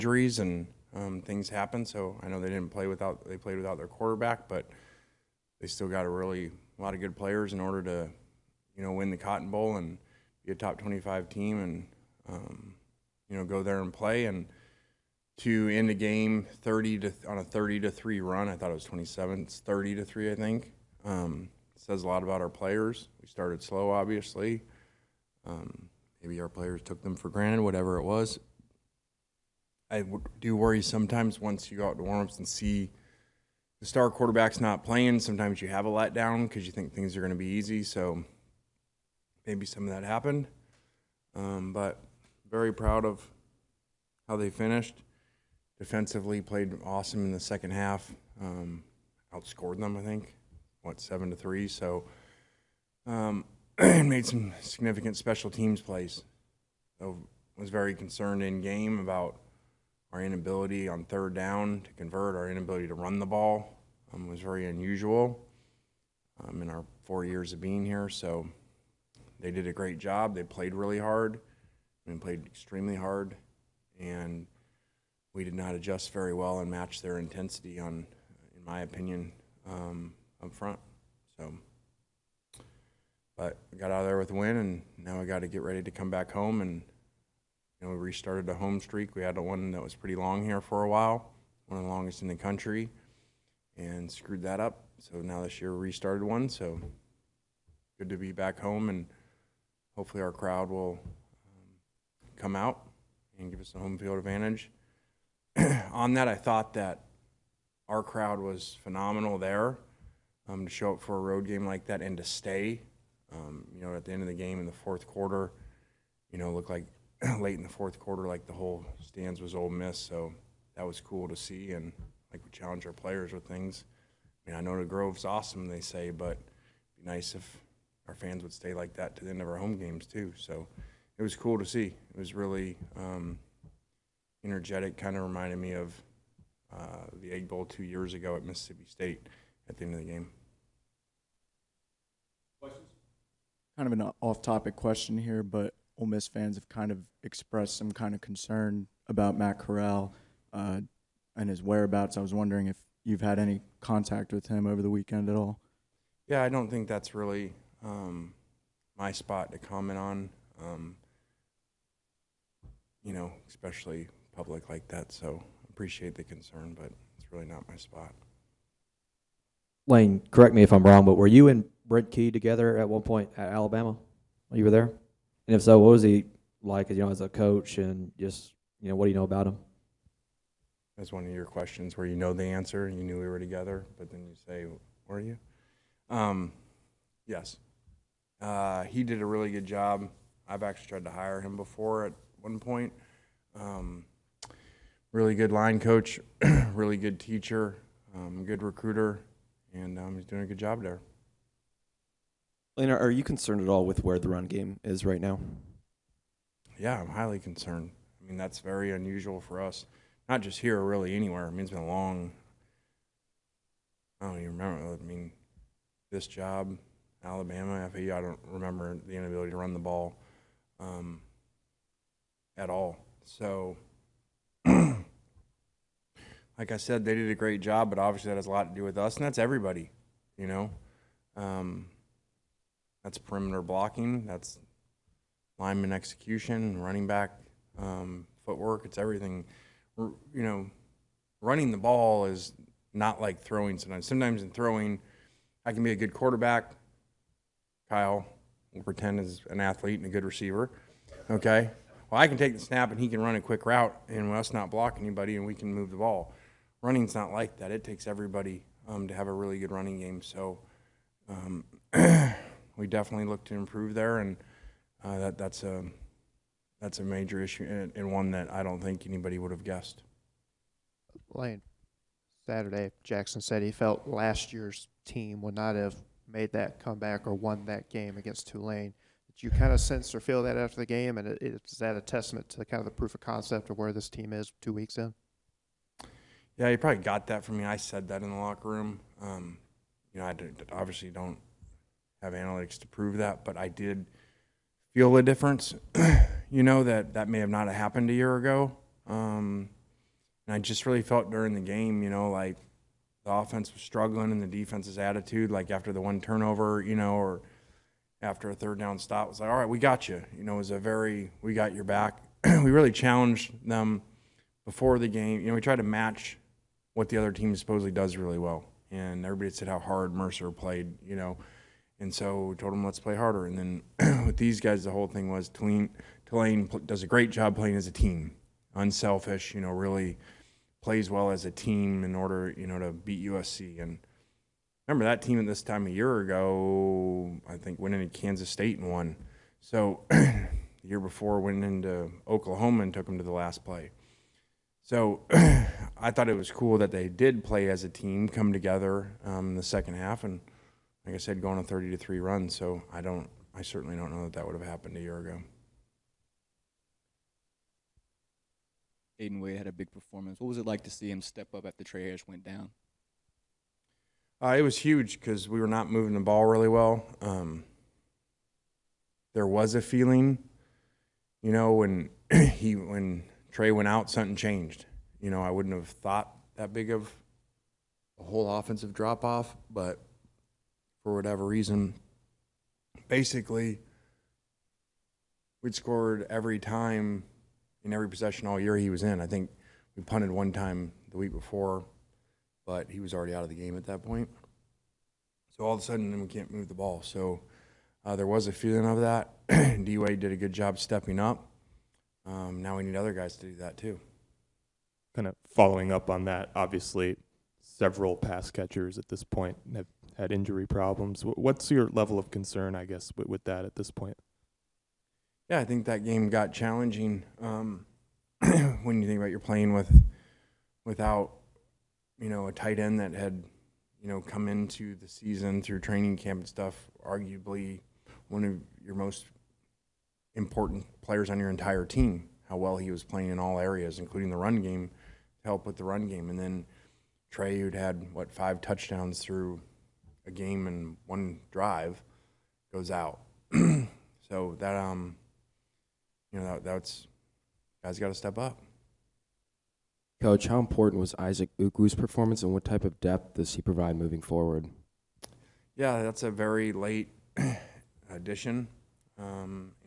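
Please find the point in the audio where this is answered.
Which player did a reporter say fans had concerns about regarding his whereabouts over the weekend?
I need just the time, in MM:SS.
02:29.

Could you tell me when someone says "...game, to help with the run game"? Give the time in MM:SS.
07:14.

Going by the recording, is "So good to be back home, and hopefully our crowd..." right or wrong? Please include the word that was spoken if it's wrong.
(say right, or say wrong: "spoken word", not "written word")
right.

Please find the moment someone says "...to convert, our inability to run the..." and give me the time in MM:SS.
01:01.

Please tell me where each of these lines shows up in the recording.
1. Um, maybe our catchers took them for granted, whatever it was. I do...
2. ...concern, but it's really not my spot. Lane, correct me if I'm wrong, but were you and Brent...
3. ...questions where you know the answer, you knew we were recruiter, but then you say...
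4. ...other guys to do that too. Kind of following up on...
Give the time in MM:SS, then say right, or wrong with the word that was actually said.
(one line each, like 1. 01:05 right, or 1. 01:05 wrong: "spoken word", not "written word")
1. 00:25 wrong: "players", not "catchers"
2. 02:46 right
3. 03:01 wrong: "together", not "recruiter"
4. 06:42 right.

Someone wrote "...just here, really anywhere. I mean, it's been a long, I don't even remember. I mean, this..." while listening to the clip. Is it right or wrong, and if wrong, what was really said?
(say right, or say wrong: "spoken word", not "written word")
right.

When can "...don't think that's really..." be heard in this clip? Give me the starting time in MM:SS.
02:36.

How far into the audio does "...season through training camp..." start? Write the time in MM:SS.
07:05.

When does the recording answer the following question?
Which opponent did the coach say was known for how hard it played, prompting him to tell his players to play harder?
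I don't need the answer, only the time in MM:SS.
05:20.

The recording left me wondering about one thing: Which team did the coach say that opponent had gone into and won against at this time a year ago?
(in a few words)
Kansas State.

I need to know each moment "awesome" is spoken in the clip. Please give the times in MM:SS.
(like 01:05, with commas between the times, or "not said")
00:46, 02:05.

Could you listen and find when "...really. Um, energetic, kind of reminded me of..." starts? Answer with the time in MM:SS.
02:12.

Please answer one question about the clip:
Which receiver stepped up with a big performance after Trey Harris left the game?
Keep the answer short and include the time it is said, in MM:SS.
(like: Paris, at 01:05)
Aiden Wade, at 05:59.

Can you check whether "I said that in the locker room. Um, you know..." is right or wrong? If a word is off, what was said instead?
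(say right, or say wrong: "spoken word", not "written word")
right.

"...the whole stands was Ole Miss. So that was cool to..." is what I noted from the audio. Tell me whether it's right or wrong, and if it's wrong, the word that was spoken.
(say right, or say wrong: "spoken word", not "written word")
right.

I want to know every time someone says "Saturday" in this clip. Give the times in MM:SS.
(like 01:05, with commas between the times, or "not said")
04:32.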